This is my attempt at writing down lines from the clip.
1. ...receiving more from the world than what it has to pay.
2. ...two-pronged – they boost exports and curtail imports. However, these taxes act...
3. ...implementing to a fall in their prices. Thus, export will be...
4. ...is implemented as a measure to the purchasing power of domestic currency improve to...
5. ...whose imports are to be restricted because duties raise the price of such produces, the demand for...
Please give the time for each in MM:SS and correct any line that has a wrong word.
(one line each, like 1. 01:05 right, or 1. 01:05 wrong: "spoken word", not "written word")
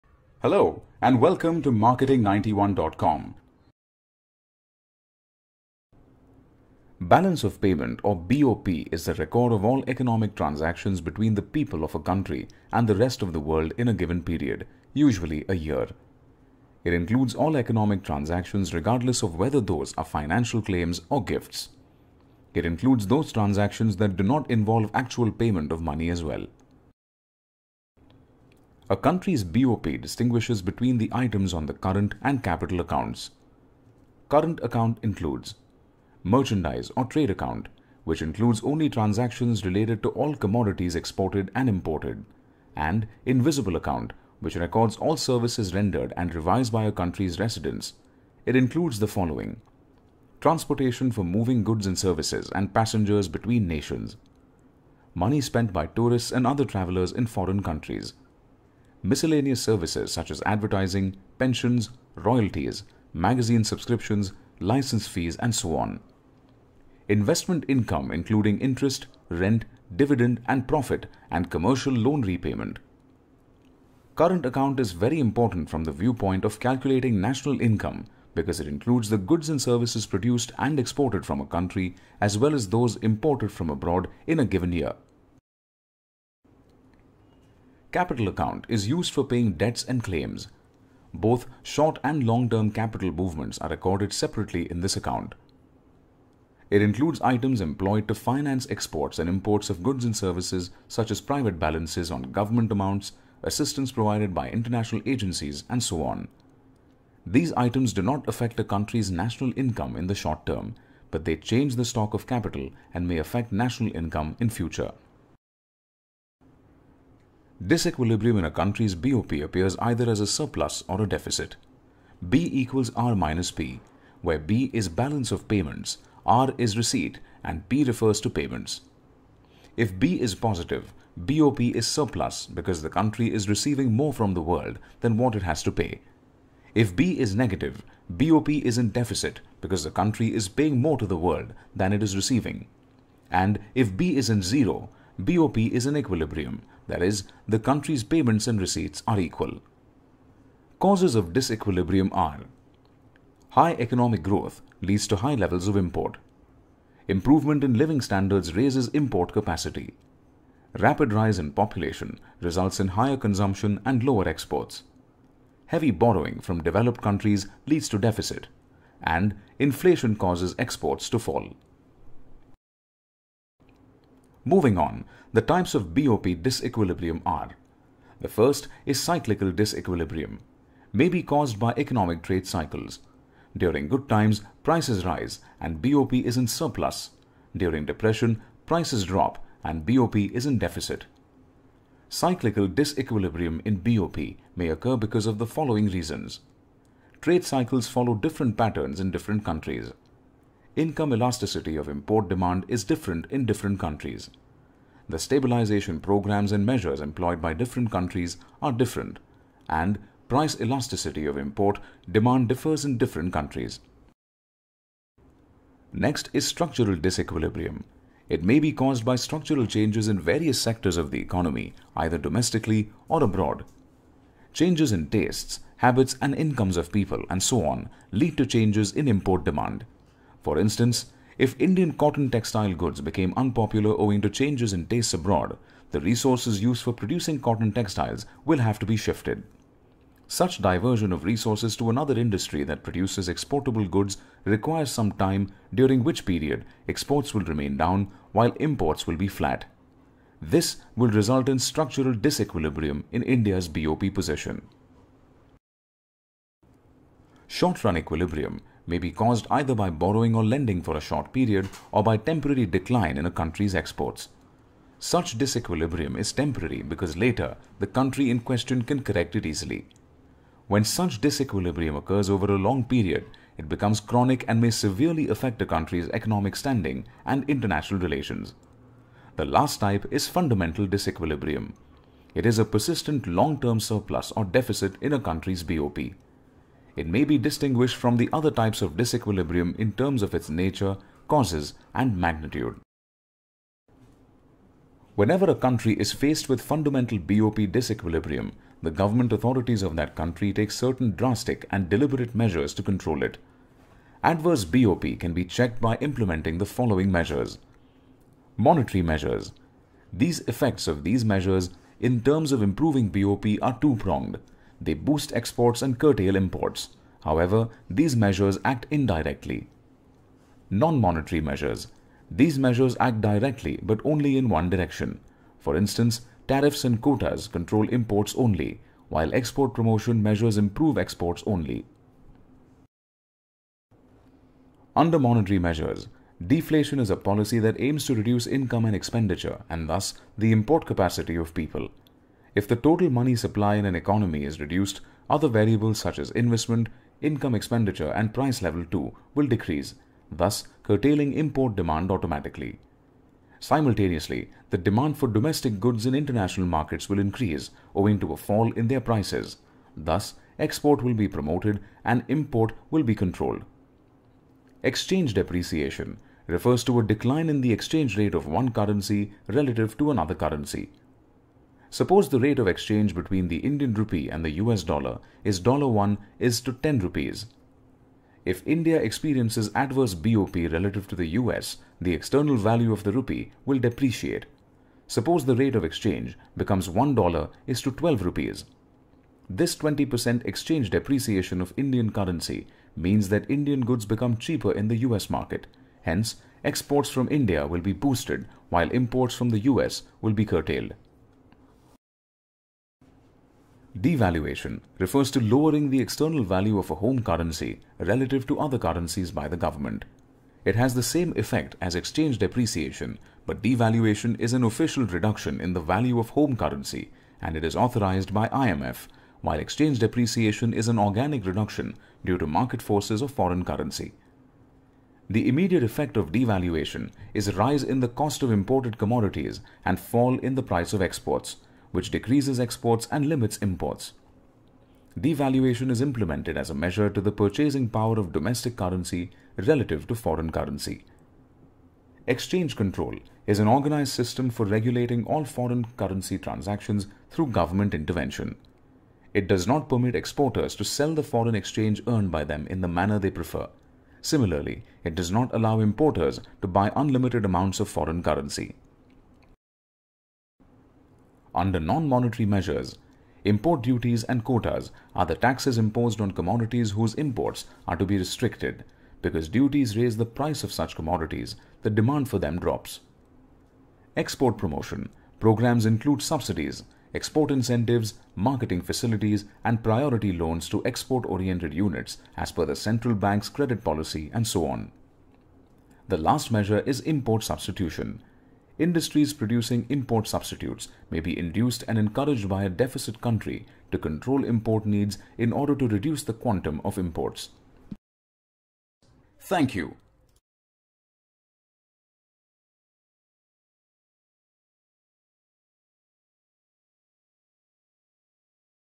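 1. 02:13 right
2. 05:13 wrong: "measures", not "taxes"
3. 05:57 wrong: "owing", not "implementing"
4. 07:15 wrong: "relative", not "improve"
5. 07:46 wrong: "commodities", not "produces".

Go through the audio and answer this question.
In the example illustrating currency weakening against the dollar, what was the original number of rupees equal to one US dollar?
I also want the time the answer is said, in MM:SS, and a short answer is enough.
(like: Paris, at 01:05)
10 rupees, at 06:16.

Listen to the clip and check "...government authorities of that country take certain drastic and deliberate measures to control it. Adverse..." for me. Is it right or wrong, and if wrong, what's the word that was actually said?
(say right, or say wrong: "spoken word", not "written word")
right.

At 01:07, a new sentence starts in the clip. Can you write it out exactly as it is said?
Investment income including interest, rent, dividend, and profit, and commercial loan repayment.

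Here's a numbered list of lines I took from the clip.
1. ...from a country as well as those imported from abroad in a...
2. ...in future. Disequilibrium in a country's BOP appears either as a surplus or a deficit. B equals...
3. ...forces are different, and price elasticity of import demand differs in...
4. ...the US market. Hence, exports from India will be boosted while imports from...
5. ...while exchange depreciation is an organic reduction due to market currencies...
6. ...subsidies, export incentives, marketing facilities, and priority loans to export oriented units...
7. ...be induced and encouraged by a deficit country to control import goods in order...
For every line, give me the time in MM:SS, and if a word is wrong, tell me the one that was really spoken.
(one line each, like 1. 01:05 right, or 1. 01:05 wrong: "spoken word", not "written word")
1. 01:21 right
2. 01:54 right
3. 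03:27 wrong: "countries", not "forces"
4. 06:34 right
5. 06:59 wrong: "forces", not "currencies"
6. 07:56 right
7. 08:11 wrong: "needs", not "goods".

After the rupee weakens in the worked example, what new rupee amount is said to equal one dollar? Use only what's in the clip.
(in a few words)
12 rupees.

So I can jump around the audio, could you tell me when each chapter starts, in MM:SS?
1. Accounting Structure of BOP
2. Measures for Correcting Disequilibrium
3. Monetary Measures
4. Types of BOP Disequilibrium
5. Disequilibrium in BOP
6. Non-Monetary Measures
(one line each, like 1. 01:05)
1. 00:34
2. 05:00
3. 05:40
4. 03:00
5. 02:02
6. 07:46.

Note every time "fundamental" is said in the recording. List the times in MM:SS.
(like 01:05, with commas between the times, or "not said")
04:40, 04:56.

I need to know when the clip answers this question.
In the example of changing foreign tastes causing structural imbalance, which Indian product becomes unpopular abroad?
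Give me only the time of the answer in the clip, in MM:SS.
03:51.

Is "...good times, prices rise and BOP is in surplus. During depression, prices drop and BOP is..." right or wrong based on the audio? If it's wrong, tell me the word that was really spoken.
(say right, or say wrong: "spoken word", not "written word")
right.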